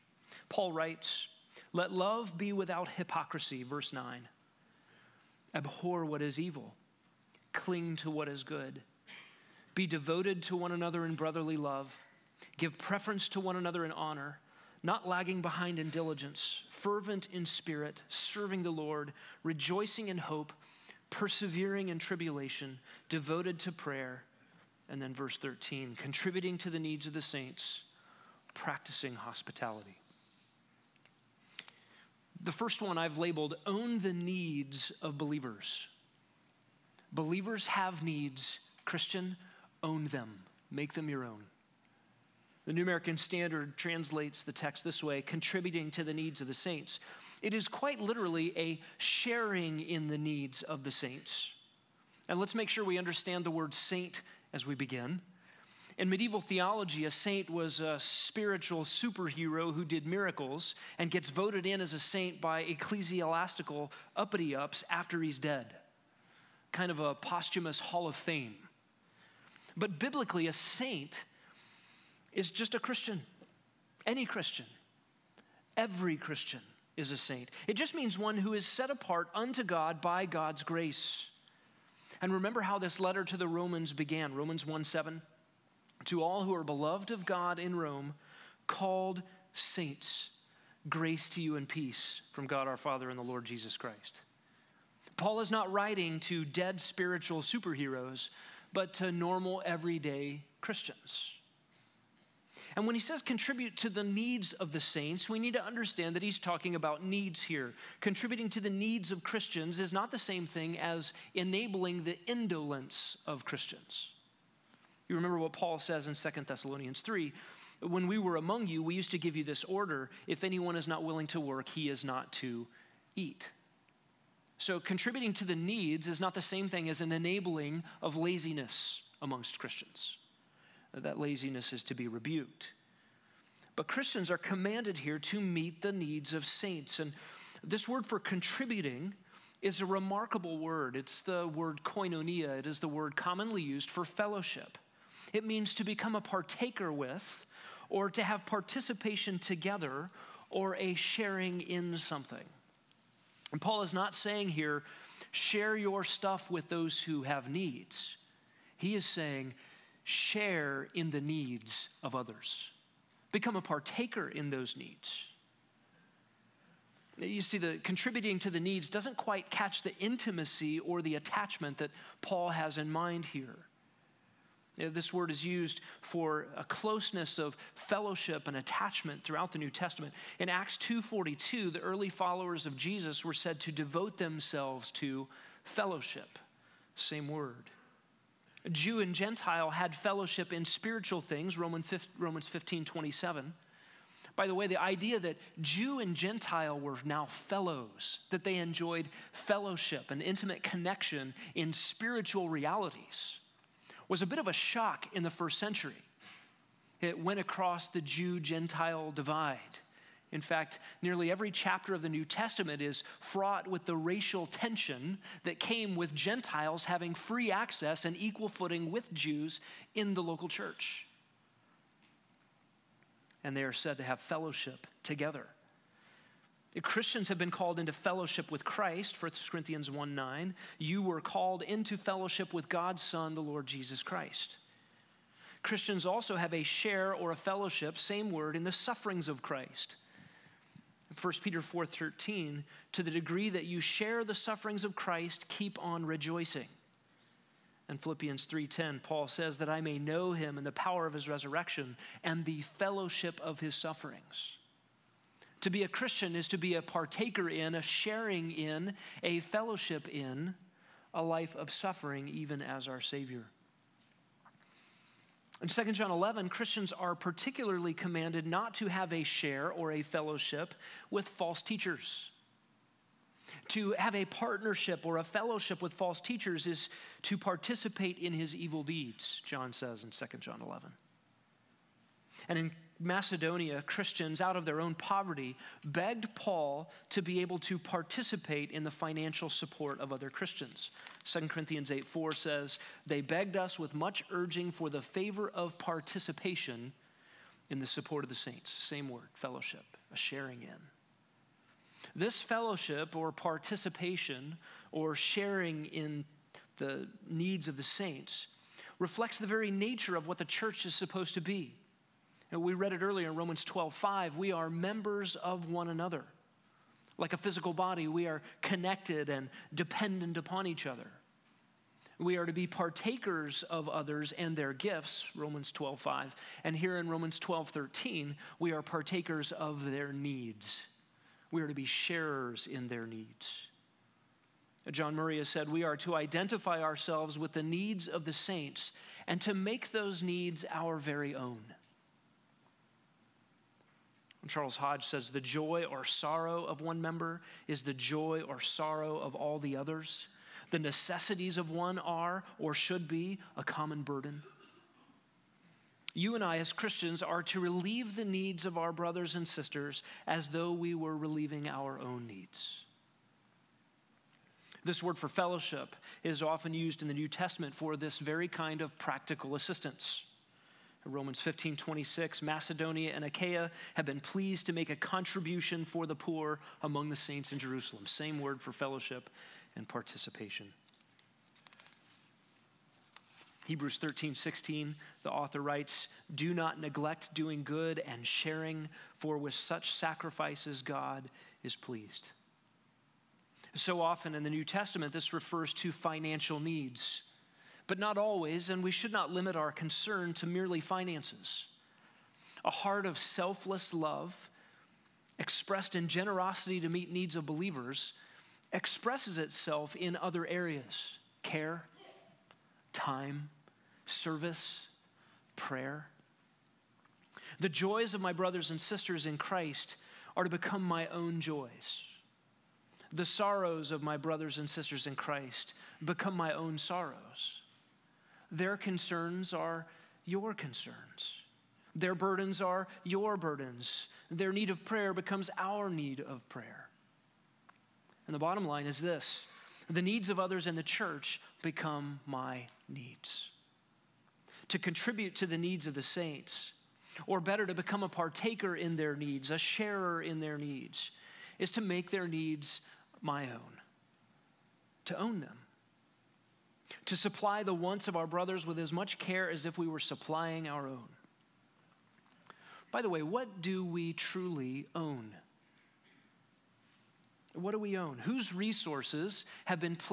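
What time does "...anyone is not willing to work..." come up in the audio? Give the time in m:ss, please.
2:00.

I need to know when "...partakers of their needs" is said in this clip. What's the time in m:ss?
5:28.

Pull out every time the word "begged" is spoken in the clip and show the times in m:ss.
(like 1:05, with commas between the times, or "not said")
4:45, 4:53.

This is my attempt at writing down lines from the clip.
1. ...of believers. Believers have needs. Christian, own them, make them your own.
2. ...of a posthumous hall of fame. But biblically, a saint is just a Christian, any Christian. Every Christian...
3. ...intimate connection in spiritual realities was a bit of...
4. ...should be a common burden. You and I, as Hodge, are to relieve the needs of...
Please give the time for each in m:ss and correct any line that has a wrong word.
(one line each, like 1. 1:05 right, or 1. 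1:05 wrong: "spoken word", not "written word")
1. 0:35 right
2. 1:06 right
3. 3:20 right
4. 5:52 wrong: "Christians", not "Hodge".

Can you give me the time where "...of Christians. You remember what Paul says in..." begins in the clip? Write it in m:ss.
1:53.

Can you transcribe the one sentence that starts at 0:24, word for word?
And then verse 13, contributing to the needs of the saints, practicing hospitality.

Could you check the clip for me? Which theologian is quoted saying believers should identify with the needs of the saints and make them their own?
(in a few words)
John Murray.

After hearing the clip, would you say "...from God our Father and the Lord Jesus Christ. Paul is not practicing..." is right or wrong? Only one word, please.
wrong.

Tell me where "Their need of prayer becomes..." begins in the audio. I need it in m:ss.
7:14.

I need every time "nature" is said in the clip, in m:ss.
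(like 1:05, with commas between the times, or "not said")
5:09.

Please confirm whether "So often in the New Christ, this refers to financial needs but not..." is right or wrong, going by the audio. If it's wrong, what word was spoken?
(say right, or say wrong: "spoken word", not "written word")
wrong: "Testament", not "Christ".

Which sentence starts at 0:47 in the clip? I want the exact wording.
It is quite literally a sharing in the needs of the saints.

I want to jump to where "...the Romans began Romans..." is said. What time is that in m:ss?
1:23.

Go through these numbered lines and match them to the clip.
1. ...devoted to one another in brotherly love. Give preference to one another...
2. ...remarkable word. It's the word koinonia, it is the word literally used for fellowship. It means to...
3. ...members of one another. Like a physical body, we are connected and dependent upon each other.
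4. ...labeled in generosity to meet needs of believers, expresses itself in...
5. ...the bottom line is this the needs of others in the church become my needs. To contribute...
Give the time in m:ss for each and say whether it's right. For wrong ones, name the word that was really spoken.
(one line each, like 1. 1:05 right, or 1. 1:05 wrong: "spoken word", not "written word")
1. 0:09 right
2. 2:19 wrong: "commonly", not "literally"
3. 5:14 right
4. 6:45 wrong: "expressed", not "labeled"
5. 7:18 right.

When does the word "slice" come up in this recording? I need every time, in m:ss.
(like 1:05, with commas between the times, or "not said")
not said.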